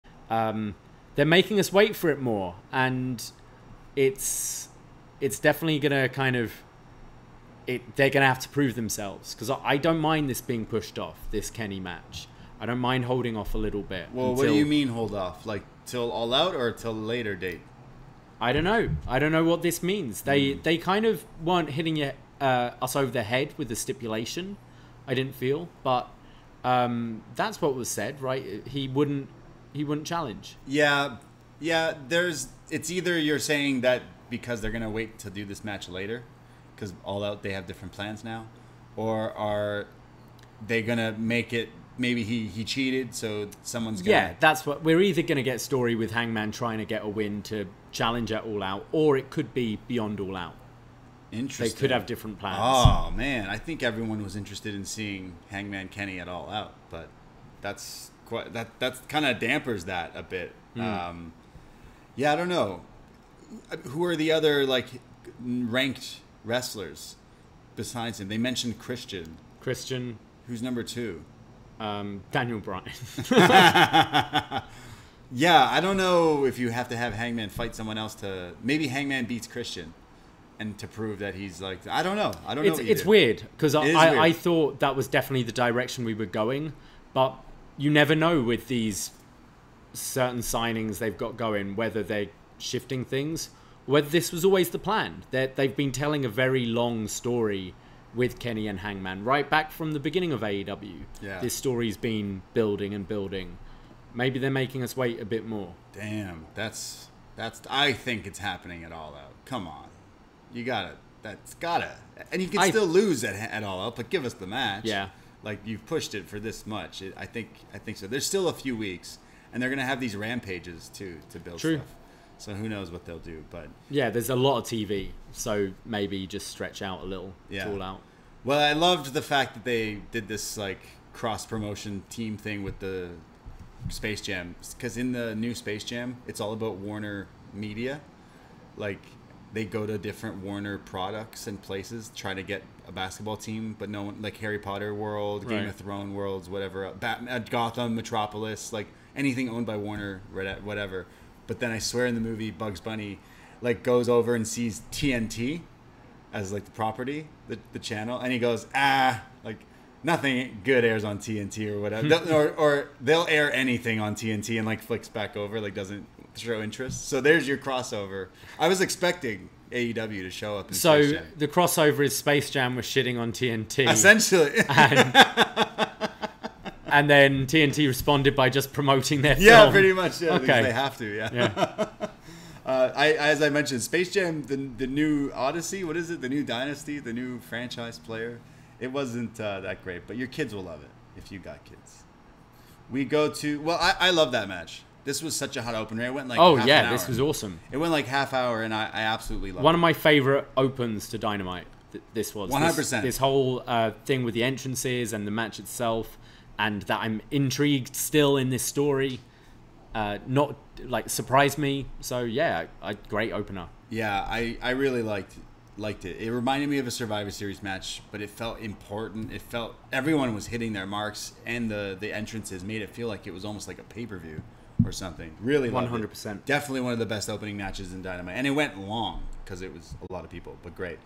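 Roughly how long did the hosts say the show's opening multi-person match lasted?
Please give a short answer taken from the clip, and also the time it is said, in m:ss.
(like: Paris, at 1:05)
half hour, at 3:18.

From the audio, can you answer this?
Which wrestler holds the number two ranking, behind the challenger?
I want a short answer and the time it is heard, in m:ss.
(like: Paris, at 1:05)
Daniel Bryan, at 1:12.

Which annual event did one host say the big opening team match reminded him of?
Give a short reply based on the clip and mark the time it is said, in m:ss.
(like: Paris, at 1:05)
Survivor Series, at 3:36.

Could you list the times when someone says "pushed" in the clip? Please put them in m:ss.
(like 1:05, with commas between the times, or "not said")
0:10, 1:55.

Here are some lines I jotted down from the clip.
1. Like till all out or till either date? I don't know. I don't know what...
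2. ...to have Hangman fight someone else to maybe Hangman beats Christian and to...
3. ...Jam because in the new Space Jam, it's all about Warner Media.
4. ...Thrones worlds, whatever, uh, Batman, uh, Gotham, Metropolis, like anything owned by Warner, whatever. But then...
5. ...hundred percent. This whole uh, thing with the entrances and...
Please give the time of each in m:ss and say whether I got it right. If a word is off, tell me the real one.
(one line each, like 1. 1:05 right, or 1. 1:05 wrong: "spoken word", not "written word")
1. 0:15 wrong: "later", not "either"
2. 1:16 right
3. 2:14 right
4. 2:25 right
5. 3:22 right.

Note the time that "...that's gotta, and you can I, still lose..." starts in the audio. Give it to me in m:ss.
1:51.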